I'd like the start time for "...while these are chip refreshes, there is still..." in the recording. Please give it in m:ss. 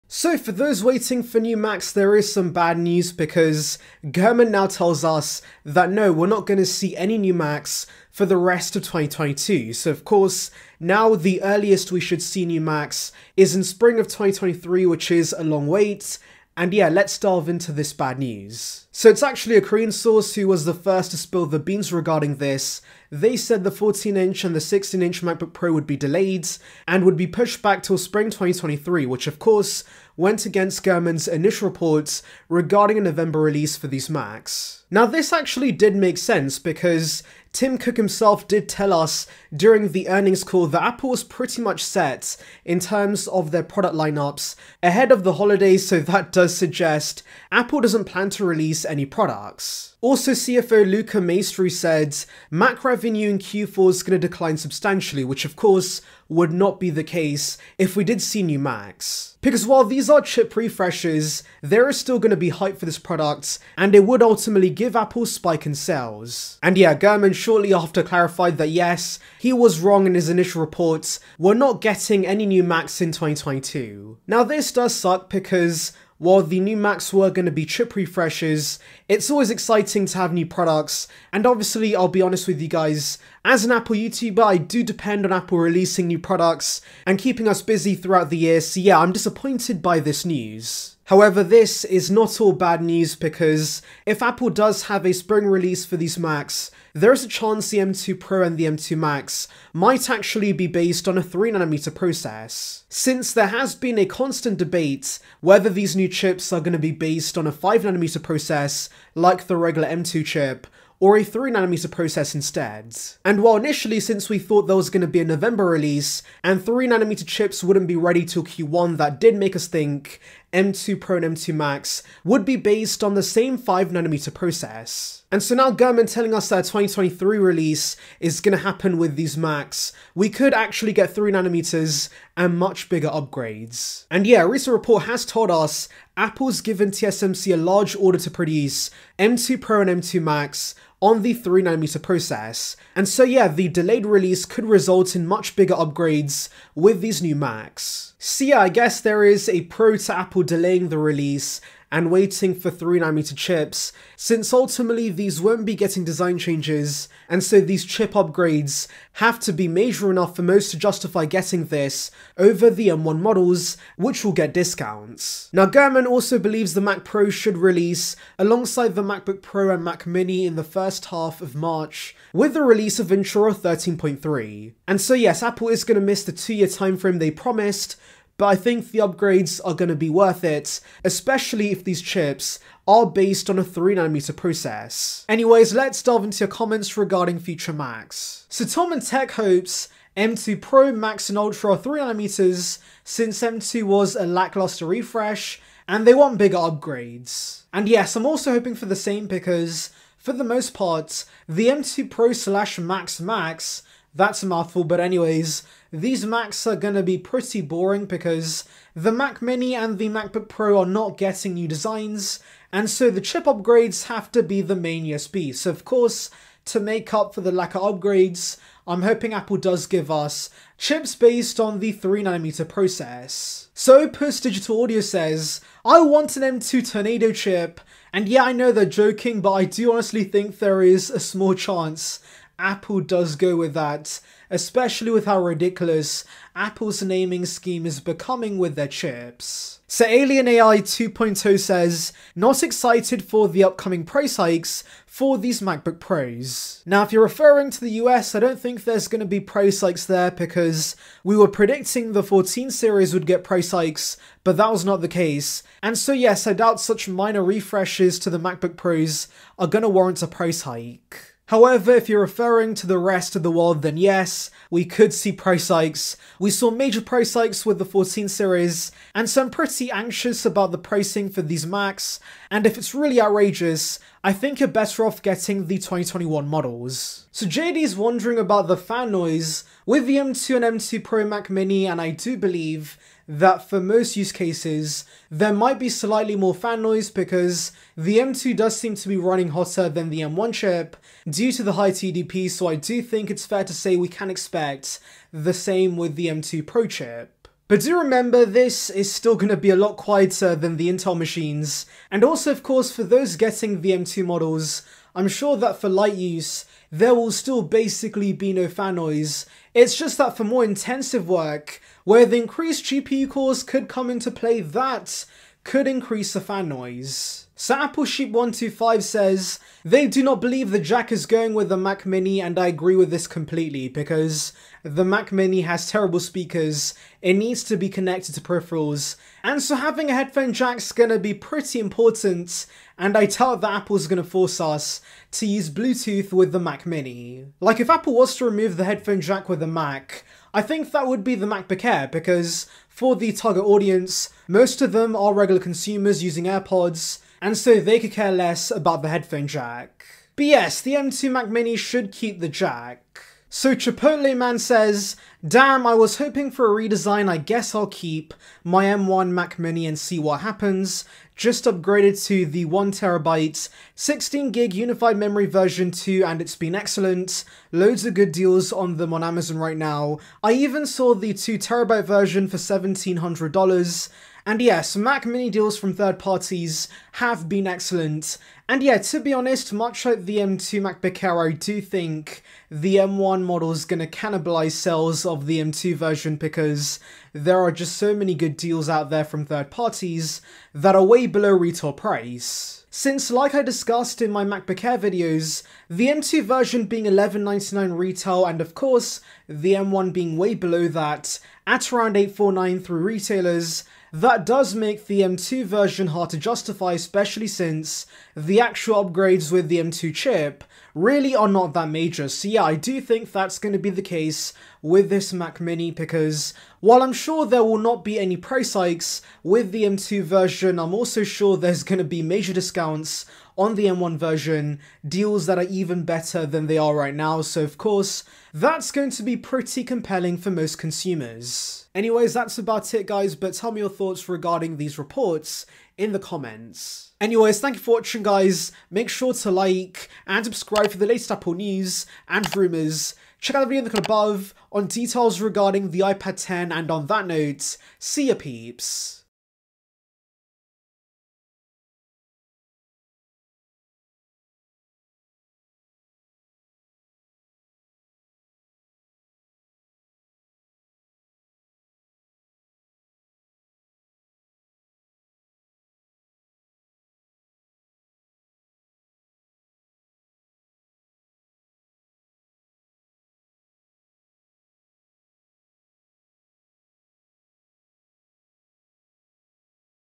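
0:59.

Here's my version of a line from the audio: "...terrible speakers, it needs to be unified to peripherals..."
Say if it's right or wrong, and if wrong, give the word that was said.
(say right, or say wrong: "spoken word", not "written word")
wrong: "connected", not "unified".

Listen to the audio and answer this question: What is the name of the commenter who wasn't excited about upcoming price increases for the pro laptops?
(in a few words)
Alien AI 2.0.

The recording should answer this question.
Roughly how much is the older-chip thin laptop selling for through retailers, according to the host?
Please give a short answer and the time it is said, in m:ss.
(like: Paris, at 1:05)
$849, at 6:42.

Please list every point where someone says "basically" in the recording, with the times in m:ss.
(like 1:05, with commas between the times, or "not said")
5:07.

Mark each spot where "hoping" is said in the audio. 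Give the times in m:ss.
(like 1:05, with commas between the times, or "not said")
3:18, 3:39, 5:56.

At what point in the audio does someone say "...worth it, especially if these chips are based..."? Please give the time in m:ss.
3:00.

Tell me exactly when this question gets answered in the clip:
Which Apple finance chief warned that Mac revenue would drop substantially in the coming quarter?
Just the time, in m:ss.
0:50.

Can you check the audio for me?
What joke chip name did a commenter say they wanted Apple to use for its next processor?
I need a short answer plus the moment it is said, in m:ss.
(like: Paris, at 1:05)
M2 Tornado, at 3:46.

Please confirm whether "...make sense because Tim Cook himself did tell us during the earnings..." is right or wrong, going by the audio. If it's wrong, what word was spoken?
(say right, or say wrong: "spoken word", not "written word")
right.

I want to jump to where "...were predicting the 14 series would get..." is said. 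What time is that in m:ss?
4:11.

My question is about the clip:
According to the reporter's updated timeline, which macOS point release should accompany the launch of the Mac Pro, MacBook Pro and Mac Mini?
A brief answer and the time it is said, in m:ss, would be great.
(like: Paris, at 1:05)
Ventura 13.3, at 2:53.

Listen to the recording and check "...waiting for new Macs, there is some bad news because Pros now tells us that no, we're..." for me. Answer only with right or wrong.
wrong.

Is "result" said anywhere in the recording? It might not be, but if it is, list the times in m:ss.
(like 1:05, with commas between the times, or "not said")
2:24.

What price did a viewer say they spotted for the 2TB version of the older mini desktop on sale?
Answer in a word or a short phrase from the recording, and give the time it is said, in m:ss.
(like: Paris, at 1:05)
$1,700, at 6:12.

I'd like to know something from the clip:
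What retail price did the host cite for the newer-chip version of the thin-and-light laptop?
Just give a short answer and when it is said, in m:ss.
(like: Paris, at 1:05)
$1,199, at 6:37.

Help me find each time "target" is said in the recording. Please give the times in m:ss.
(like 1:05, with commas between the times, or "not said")
5:43.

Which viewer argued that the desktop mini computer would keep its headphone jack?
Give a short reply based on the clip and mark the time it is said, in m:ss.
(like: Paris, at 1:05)
AppleSheep125, at 5:17.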